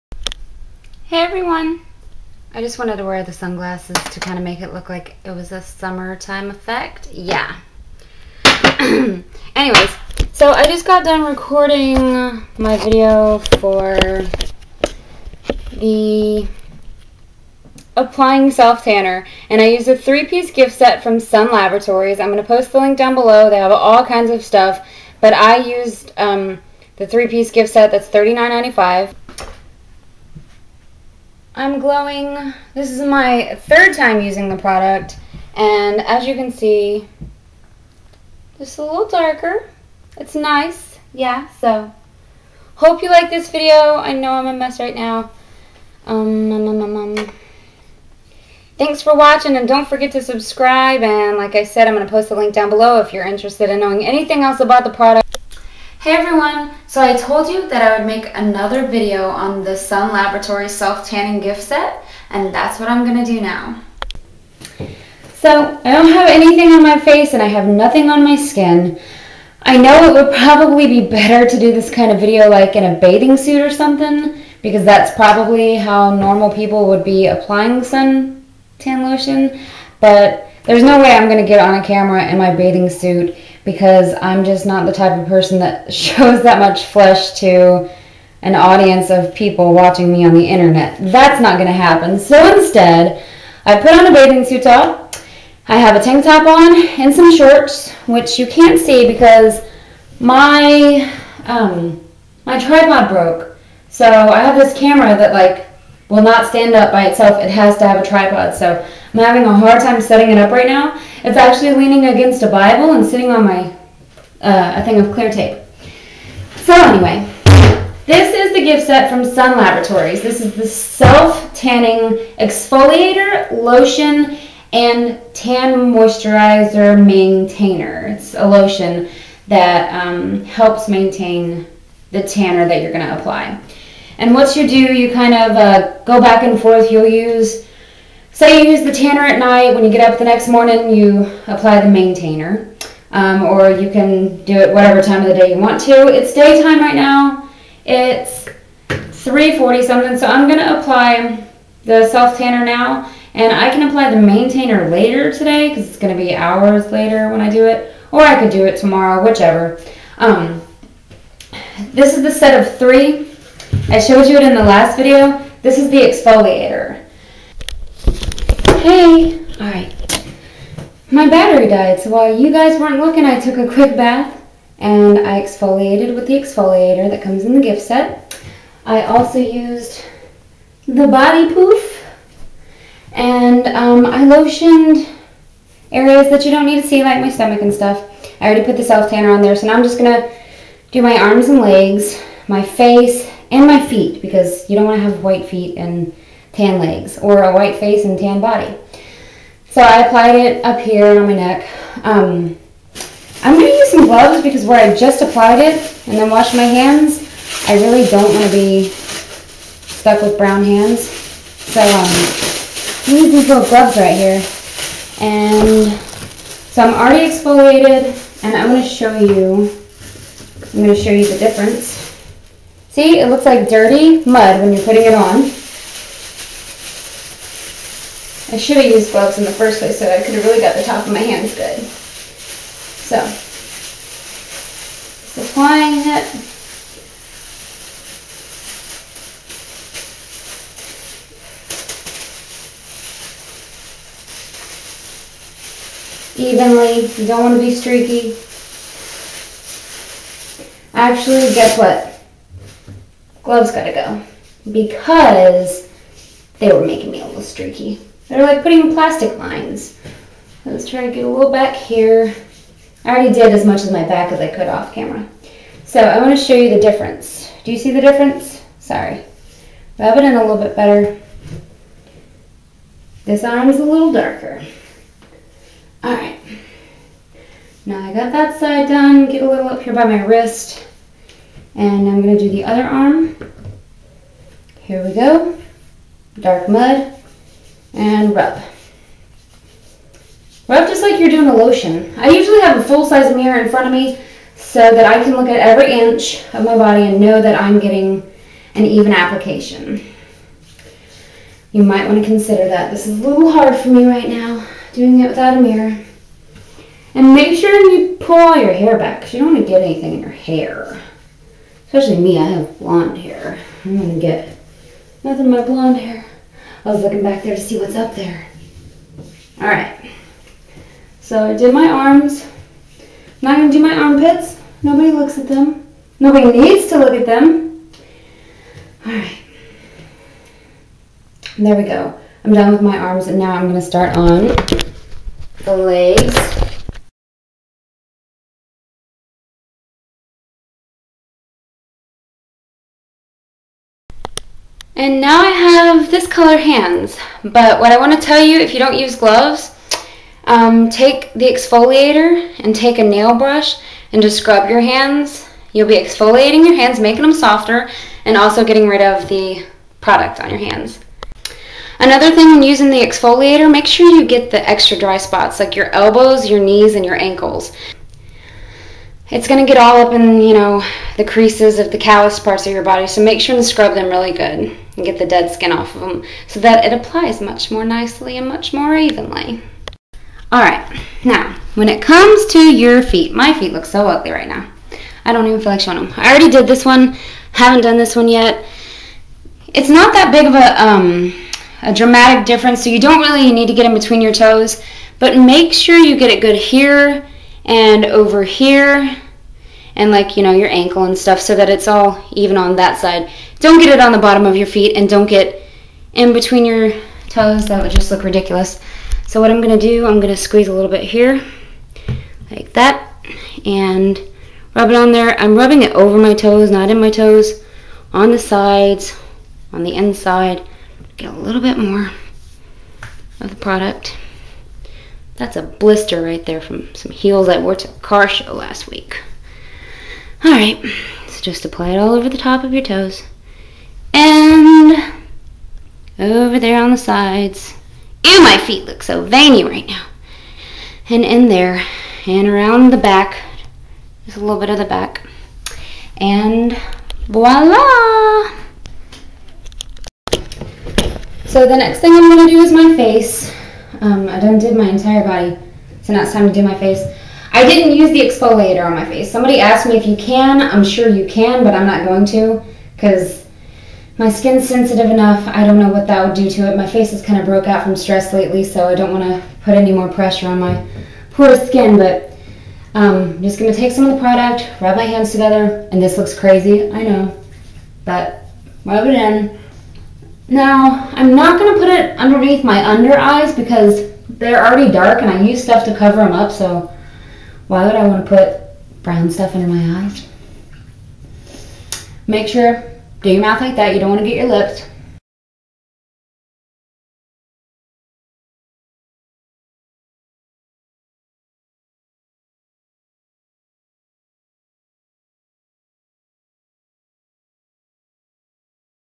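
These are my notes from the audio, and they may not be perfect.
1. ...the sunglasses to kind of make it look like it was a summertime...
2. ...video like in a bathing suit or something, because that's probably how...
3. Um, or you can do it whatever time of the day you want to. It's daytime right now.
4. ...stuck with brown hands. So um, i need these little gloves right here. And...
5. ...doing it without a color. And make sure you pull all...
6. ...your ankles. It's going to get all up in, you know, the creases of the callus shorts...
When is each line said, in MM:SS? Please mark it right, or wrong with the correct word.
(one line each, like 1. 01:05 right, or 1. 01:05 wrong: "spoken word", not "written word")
1. 00:03 right
2. 01:12 right
3. 02:23 right
4. 03:28 right
5. 05:04 wrong: "mirror", not "color"
6. 06:07 wrong: "parts", not "shorts".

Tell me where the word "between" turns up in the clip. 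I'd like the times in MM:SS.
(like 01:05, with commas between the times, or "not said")
06:33, 06:46.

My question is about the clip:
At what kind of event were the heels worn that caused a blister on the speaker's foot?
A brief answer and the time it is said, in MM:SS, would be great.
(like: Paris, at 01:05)
Car show, at 07:07.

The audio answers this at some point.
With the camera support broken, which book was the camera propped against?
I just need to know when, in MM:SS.
01:52.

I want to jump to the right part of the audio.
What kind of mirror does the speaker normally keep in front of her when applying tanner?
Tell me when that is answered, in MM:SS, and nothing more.
04:52.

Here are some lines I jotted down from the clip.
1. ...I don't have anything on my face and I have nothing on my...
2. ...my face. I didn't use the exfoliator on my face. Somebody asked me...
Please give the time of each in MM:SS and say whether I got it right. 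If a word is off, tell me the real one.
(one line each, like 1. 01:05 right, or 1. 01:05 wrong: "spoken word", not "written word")
1. 01:05 right
2. 07:36 right.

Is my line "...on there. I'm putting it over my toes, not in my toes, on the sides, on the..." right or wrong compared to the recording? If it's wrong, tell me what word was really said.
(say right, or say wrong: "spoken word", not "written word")
wrong: "rubbing", not "putting".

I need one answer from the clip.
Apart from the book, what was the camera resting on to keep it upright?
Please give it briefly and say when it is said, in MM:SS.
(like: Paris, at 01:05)
Clear tape, at 01:55.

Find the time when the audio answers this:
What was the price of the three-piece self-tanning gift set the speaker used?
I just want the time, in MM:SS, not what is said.
00:28.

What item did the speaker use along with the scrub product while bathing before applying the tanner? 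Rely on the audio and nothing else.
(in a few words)
Body poof.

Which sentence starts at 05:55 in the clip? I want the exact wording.
You'll be exfoliating your hands, making them softer, and also getting rid of the product on your hands.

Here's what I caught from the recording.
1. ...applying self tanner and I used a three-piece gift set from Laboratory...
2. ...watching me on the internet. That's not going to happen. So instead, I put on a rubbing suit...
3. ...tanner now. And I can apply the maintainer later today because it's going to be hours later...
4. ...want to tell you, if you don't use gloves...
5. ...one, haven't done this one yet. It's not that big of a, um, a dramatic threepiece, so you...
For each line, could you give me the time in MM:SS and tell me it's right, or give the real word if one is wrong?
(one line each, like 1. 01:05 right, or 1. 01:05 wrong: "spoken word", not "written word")
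1. 00:17 wrong: "Sun", not "Laboratory"
2. 01:29 wrong: "bathing", not "rubbing"
3. 02:32 right
4. 05:47 right
5. 06:26 wrong: "difference", not "threepiece".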